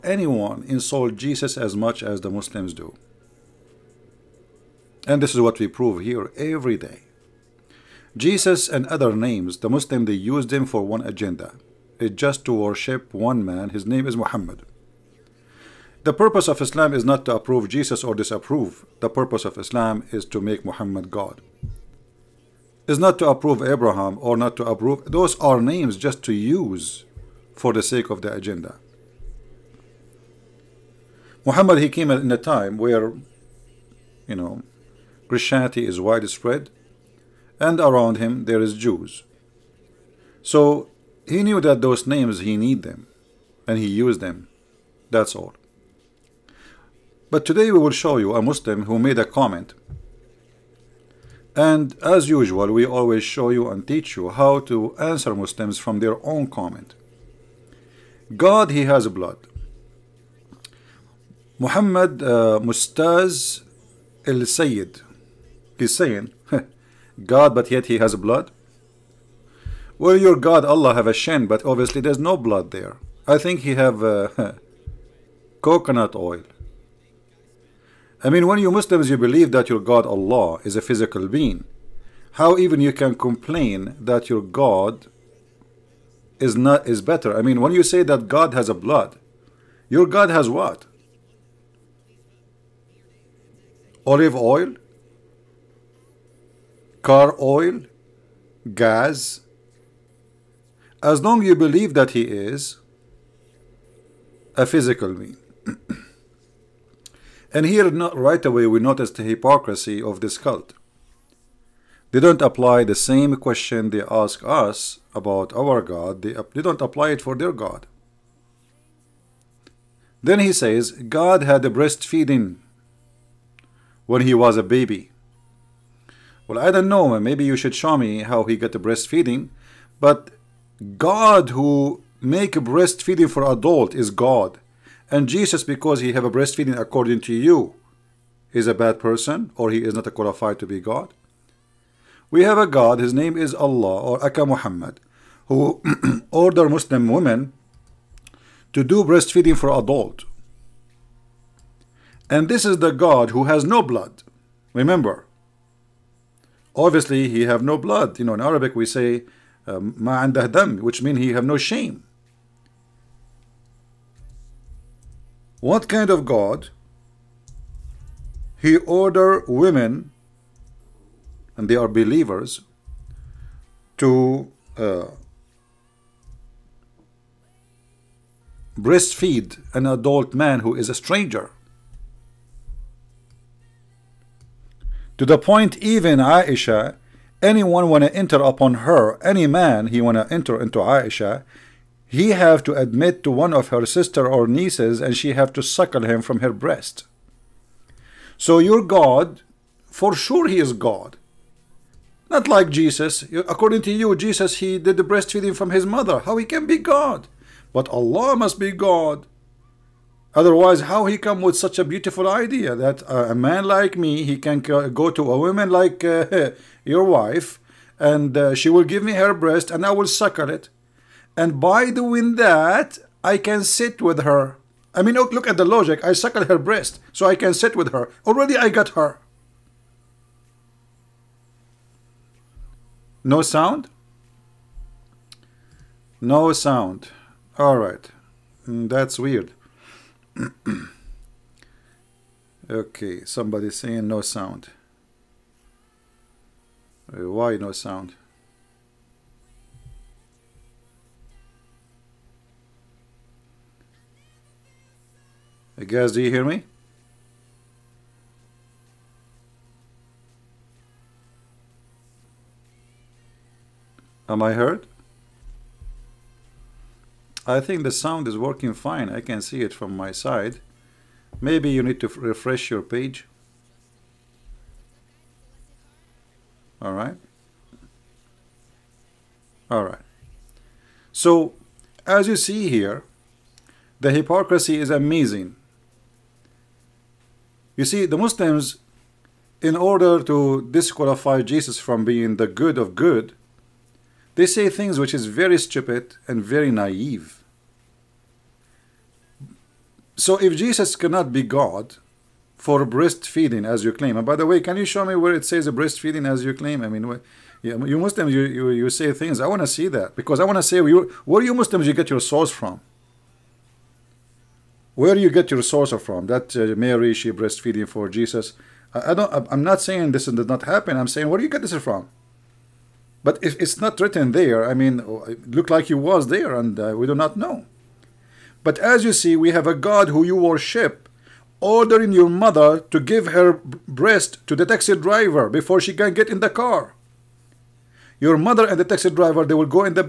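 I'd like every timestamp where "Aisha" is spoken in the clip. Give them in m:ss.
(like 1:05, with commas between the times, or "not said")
3:06, 3:10.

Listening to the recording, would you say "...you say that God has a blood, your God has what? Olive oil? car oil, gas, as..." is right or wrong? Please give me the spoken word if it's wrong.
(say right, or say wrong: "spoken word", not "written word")
right.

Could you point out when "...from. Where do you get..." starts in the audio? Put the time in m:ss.
5:12.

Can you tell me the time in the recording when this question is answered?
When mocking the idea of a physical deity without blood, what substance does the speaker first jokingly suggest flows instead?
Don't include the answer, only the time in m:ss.
1:15.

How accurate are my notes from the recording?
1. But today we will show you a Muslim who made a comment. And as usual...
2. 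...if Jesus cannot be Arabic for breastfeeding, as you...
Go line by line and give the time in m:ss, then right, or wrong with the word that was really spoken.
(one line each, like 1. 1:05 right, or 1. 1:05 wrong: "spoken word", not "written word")
1. 0:47 right
2. 5:00 wrong: "God", not "Arabic".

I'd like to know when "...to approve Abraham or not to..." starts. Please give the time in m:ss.
0:23.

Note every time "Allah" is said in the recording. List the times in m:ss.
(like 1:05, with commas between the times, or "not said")
1:10, 1:20, 2:23, 3:27.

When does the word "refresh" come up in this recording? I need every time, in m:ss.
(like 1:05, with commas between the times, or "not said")
4:32.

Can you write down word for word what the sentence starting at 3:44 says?
I mean, look, look at the logic.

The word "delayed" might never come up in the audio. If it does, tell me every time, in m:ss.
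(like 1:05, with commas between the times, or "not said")
not said.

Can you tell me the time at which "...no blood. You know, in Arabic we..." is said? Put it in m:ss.
2:37.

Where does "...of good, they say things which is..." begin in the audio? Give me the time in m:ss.
4:52.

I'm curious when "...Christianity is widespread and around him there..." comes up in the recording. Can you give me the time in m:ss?
0:35.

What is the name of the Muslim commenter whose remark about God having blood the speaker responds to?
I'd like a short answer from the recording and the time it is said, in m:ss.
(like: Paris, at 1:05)
Mustaz El Sayyid, at 1:02.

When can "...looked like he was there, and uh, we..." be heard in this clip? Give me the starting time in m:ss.
5:25.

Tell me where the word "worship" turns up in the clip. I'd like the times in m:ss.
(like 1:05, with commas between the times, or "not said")
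0:12, 5:30.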